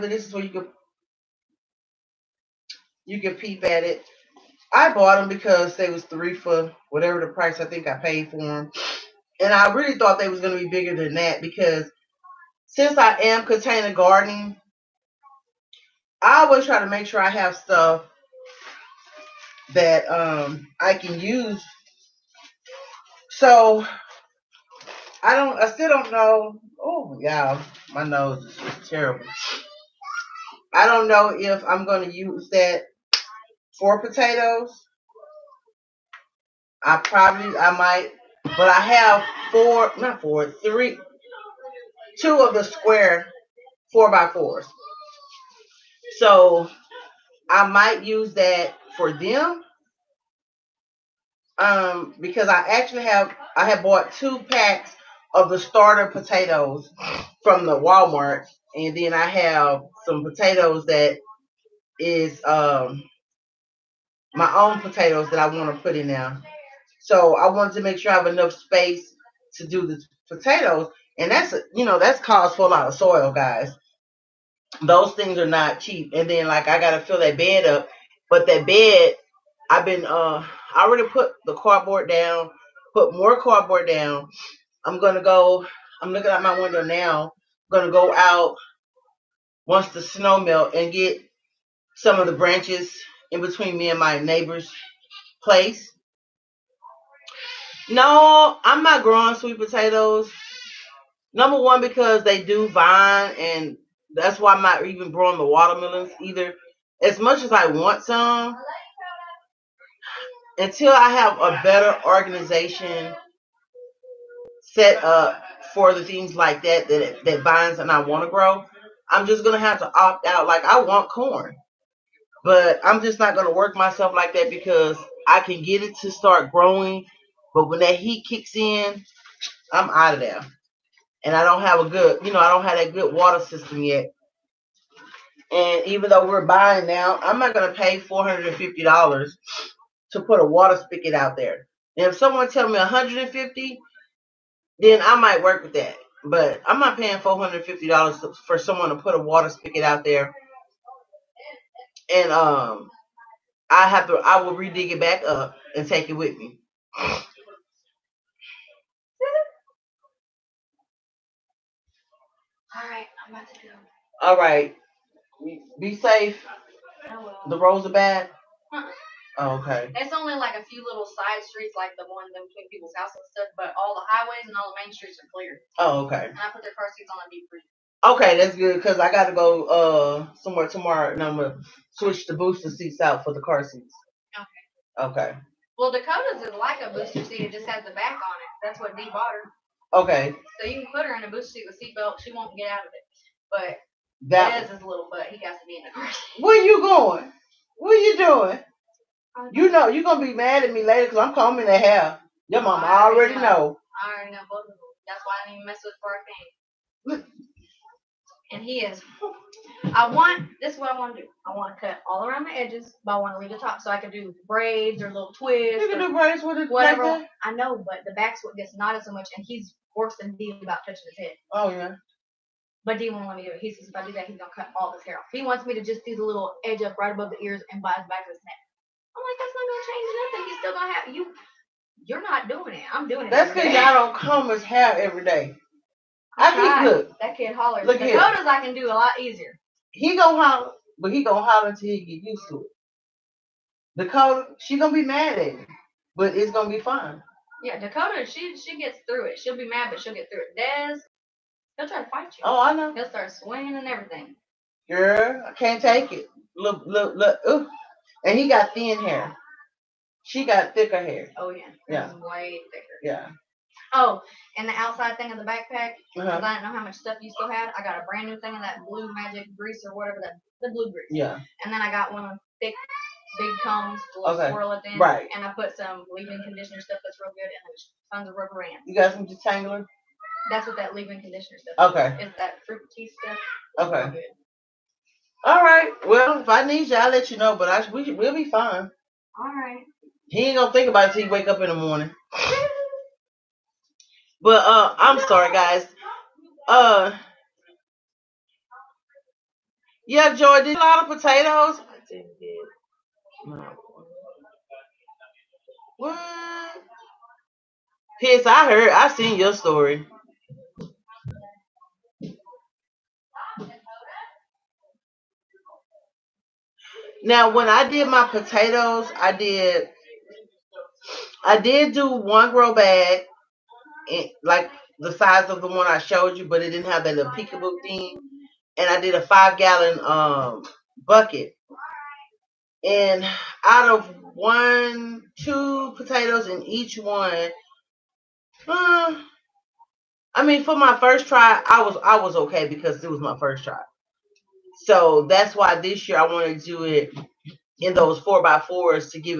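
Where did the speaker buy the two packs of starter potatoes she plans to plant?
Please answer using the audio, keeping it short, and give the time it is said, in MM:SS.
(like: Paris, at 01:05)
Walmart, at 00:57.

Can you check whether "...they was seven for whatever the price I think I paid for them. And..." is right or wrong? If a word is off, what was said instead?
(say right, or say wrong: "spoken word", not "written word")
wrong: "three", not "seven".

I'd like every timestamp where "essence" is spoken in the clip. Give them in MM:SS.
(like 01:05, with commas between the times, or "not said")
not said.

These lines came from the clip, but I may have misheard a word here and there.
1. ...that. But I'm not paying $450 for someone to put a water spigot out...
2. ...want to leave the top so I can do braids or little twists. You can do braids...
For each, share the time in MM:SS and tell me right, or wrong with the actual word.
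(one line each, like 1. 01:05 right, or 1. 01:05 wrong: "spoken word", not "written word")
1. 02:25 right
2. 03:33 right.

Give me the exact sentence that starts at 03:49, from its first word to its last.
I'm like, that's not gonna change nothing.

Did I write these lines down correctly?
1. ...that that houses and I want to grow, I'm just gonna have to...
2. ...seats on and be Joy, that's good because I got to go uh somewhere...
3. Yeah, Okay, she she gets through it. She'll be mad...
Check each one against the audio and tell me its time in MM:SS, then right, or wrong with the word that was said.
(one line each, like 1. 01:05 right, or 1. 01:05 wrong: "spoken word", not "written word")
1. 01:56 wrong: "vines", not "houses"
2. 02:56 wrong: "Okay", not "Joy"
3. 04:07 wrong: "Dakota", not "Okay".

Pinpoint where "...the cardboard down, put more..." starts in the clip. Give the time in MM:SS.
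01:21.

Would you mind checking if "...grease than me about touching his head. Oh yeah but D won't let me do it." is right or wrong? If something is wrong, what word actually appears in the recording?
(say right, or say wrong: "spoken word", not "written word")
wrong: "worse", not "grease".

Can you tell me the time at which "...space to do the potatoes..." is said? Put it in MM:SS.
01:08.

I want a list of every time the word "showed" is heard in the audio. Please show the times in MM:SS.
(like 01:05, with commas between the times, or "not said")
05:25.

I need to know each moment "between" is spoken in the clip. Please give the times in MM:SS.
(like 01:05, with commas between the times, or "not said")
01:33, 02:52.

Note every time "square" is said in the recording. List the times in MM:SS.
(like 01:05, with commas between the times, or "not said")
00:42.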